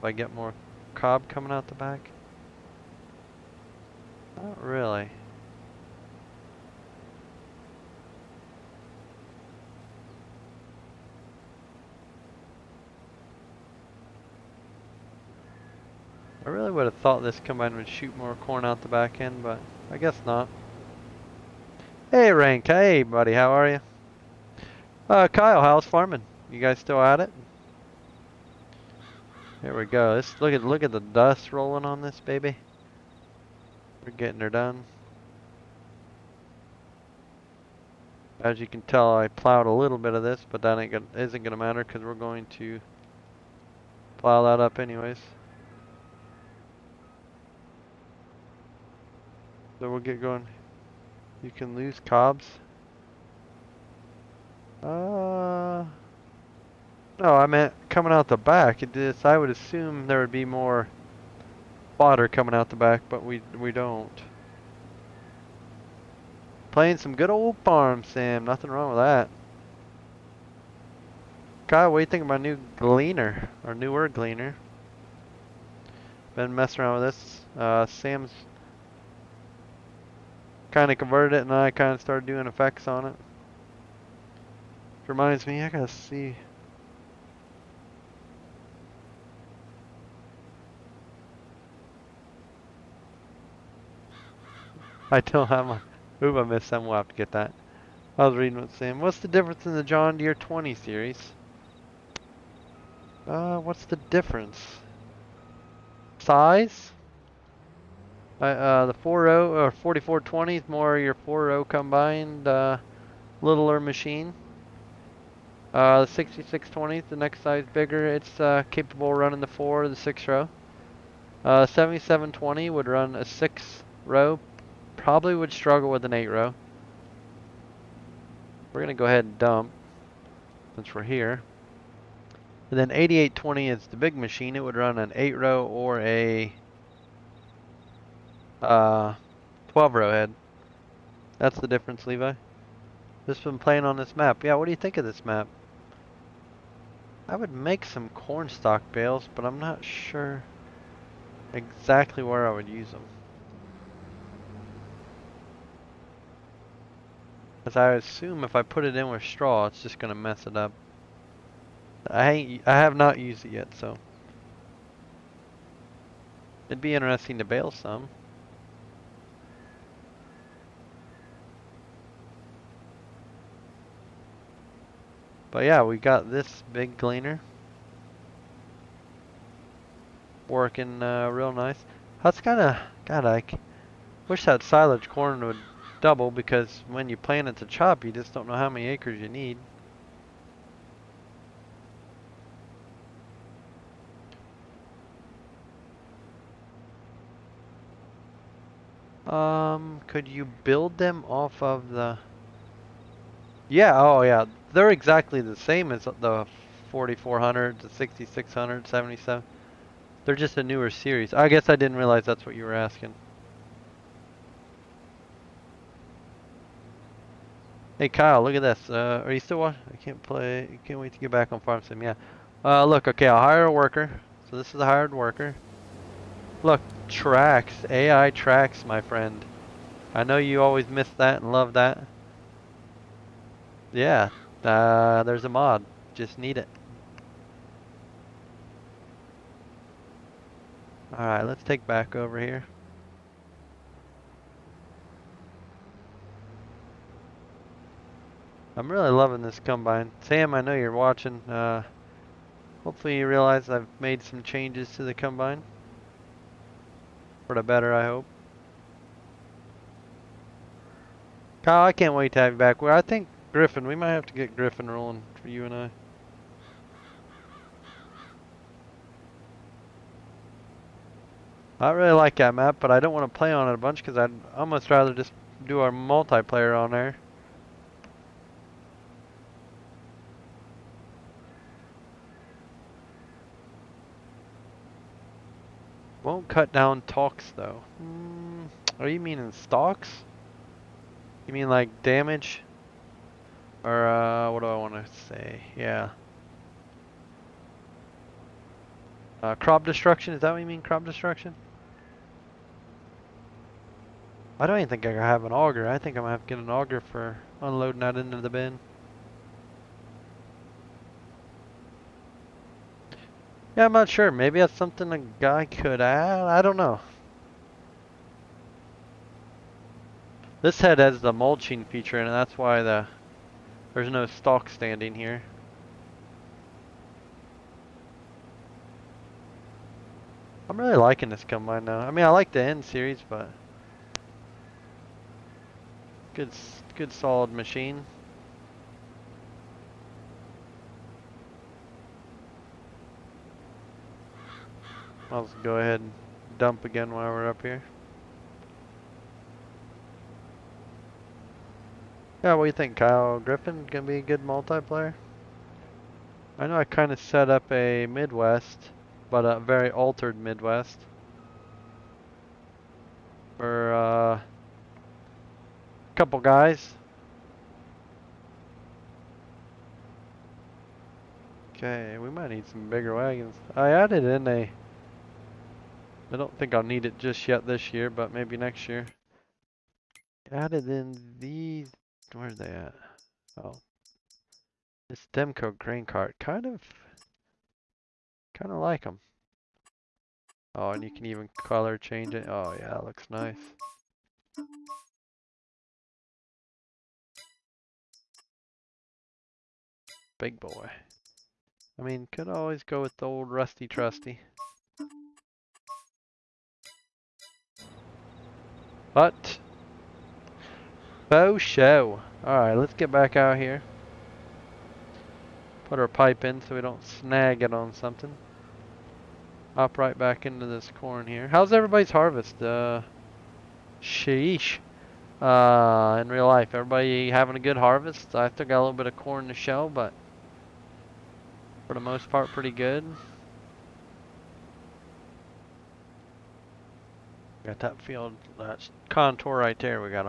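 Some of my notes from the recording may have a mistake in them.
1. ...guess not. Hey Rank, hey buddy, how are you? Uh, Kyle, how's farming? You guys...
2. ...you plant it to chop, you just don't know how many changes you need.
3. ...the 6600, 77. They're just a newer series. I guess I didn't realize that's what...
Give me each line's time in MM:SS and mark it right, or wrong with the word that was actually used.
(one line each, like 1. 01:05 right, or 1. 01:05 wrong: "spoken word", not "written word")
1. 00:19 right
2. 03:07 wrong: "acres", not "changes"
3. 03:27 right.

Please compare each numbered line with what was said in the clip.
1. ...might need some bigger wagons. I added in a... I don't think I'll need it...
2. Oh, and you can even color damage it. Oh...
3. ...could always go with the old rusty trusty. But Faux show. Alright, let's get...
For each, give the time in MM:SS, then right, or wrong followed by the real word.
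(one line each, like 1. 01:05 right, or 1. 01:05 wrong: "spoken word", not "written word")
1. 06:12 right
2. 06:30 wrong: "change", not "damage"
3. 06:42 right.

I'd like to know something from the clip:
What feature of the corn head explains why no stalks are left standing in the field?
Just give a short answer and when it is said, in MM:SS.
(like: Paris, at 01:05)
mulching feature, at 05:21.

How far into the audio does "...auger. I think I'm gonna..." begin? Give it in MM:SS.
05:05.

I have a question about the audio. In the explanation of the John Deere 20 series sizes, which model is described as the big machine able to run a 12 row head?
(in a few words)
8820.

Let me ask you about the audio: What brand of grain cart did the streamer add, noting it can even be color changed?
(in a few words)
Demco.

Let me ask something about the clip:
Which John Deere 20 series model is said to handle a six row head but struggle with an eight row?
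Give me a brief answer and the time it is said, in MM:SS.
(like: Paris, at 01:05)
7720, at 02:01.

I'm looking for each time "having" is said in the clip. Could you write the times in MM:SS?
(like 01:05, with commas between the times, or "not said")
07:07.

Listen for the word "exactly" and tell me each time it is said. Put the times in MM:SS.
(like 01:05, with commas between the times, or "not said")
02:31, 03:24.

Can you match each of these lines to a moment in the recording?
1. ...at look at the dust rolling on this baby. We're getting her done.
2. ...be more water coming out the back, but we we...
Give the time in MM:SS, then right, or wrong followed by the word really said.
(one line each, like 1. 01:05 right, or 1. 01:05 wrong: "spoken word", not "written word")
1. 00:30 right
2. 01:00 right.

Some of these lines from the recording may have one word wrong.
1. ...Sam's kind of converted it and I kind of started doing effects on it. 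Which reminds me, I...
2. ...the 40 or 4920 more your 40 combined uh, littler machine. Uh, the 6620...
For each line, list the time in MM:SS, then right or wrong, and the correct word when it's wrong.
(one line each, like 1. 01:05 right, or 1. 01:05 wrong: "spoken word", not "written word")
1. 01:17 right
2. 01:48 wrong: "4420", not "4920".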